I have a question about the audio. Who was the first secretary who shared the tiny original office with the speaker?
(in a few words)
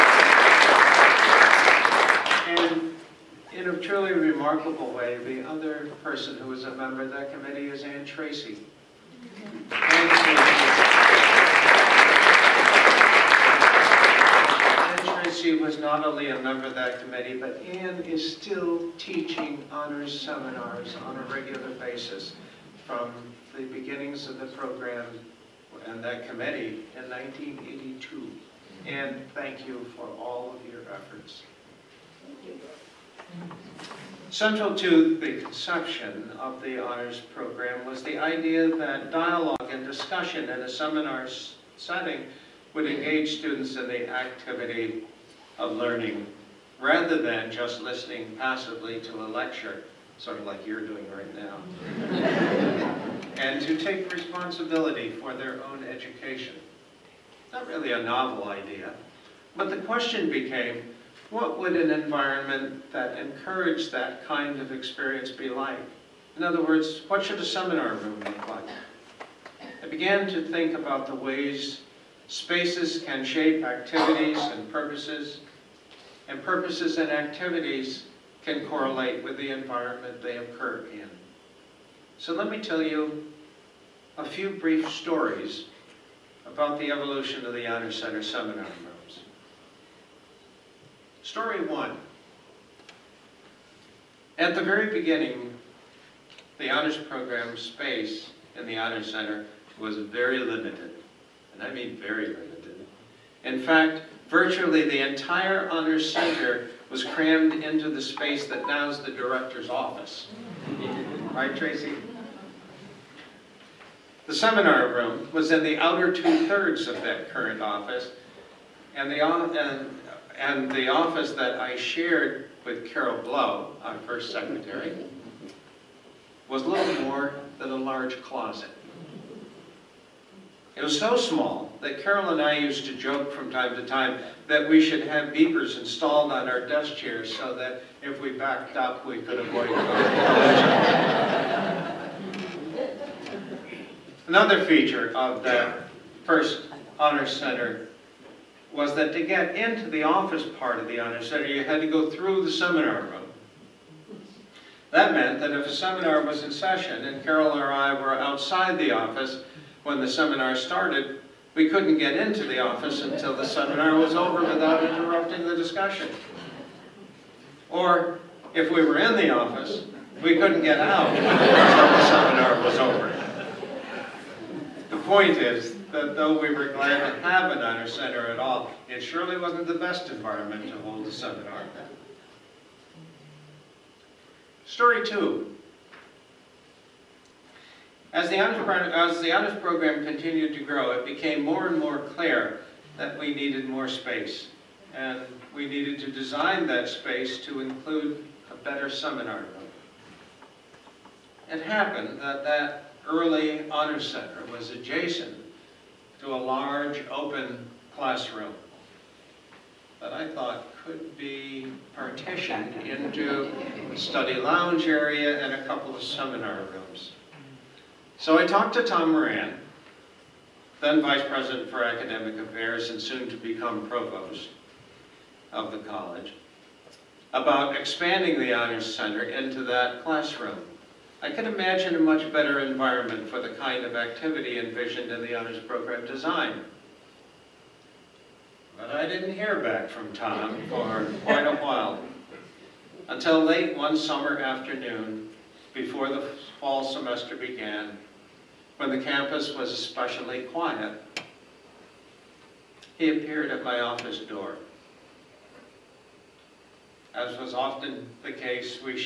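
Carol Blow.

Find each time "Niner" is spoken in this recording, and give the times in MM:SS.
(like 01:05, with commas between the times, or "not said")
02:57.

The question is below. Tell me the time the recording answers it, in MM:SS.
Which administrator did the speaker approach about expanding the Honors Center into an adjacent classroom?
03:38.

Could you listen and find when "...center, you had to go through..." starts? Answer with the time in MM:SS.
02:31.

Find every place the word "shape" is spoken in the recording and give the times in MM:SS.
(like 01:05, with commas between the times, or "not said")
01:13.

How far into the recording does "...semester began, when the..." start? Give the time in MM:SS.
04:06.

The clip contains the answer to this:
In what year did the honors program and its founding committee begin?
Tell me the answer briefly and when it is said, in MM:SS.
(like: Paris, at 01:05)
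1982, at 00:27.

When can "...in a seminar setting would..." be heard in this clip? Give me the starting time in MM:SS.
00:40.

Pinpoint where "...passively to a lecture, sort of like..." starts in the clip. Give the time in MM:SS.
00:48.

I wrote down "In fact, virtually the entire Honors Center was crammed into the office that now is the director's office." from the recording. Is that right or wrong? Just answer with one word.
wrong.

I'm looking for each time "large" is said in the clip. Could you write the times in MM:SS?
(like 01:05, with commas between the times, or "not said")
02:07, 03:26.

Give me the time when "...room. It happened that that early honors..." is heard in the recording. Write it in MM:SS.
03:19.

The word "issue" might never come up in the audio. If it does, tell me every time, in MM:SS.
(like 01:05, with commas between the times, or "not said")
not said.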